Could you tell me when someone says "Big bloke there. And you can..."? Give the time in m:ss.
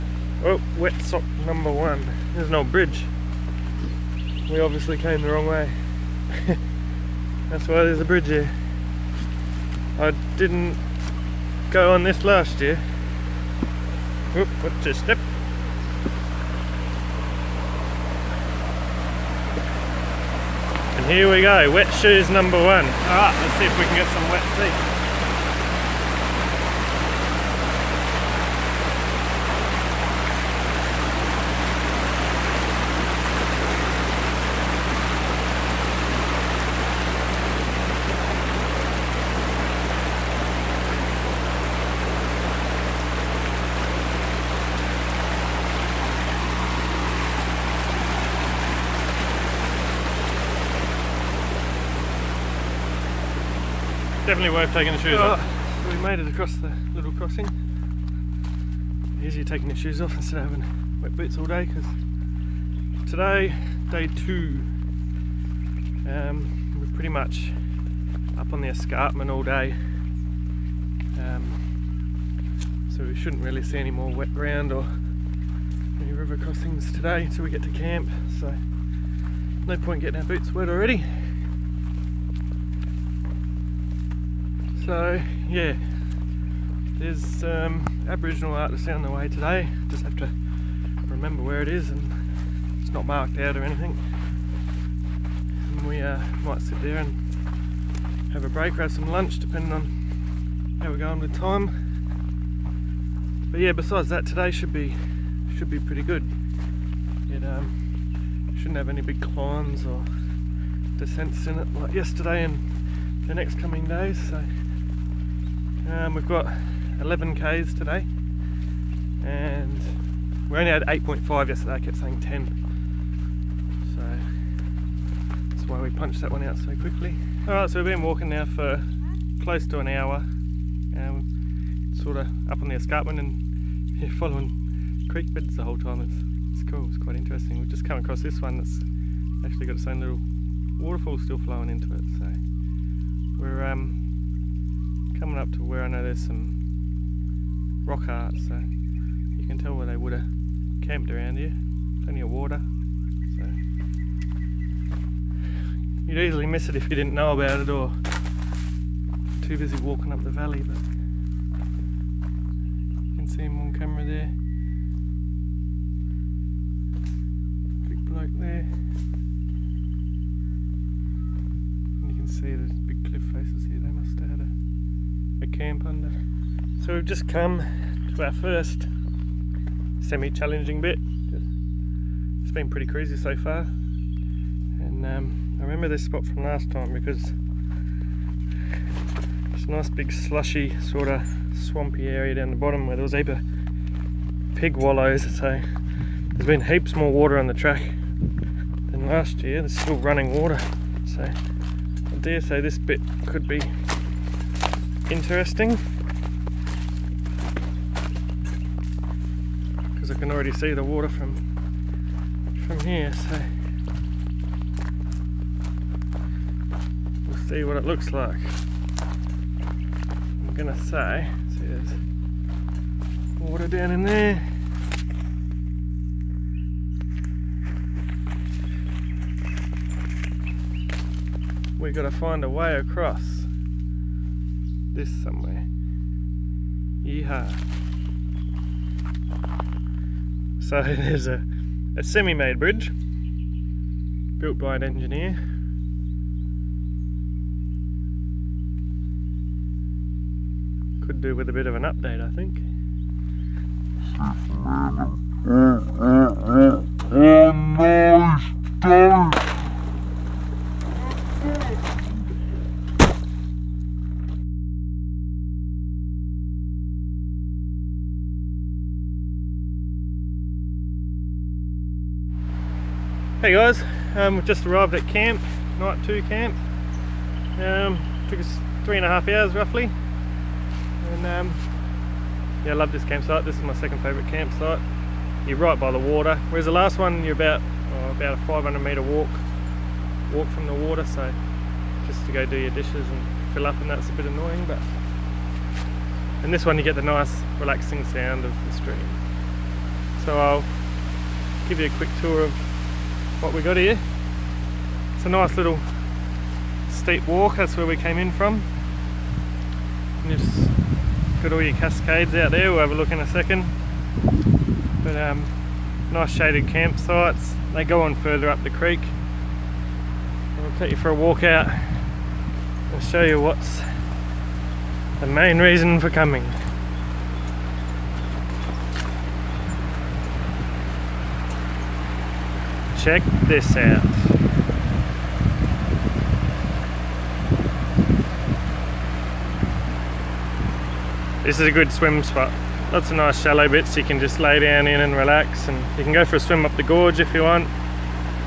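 2:47.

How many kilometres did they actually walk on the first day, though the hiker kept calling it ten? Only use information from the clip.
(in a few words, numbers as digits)
8.5.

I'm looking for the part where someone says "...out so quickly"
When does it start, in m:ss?
2:06.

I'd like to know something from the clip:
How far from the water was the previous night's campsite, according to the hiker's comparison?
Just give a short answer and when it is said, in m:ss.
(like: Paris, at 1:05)
500 metres, at 4:48.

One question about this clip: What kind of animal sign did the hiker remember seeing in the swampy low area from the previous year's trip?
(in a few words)
pig wallows.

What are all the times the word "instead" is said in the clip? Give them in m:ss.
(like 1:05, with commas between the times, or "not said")
1:00.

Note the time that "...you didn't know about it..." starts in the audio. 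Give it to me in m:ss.
2:36.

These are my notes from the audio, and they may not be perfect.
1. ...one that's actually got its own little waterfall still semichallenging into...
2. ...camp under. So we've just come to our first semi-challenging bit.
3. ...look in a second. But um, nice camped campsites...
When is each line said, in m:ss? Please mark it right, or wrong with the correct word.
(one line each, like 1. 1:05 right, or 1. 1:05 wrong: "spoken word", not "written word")
1. 2:18 wrong: "flowing", not "semichallenging"
2. 2:55 right
3. 5:12 wrong: "shaded", not "camped".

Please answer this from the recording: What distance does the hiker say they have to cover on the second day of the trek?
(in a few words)
11 km.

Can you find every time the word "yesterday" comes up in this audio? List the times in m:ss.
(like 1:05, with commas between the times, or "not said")
1:51, 2:01.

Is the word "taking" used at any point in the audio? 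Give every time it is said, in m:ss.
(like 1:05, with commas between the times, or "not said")
0:54, 0:59.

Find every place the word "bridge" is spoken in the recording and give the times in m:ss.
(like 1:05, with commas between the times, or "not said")
0:02, 0:08, 4:02.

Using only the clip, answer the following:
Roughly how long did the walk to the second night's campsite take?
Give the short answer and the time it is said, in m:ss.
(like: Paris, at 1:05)
3.5 hours, at 4:38.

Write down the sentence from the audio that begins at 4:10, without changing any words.
Could do with a bit of an update, I think.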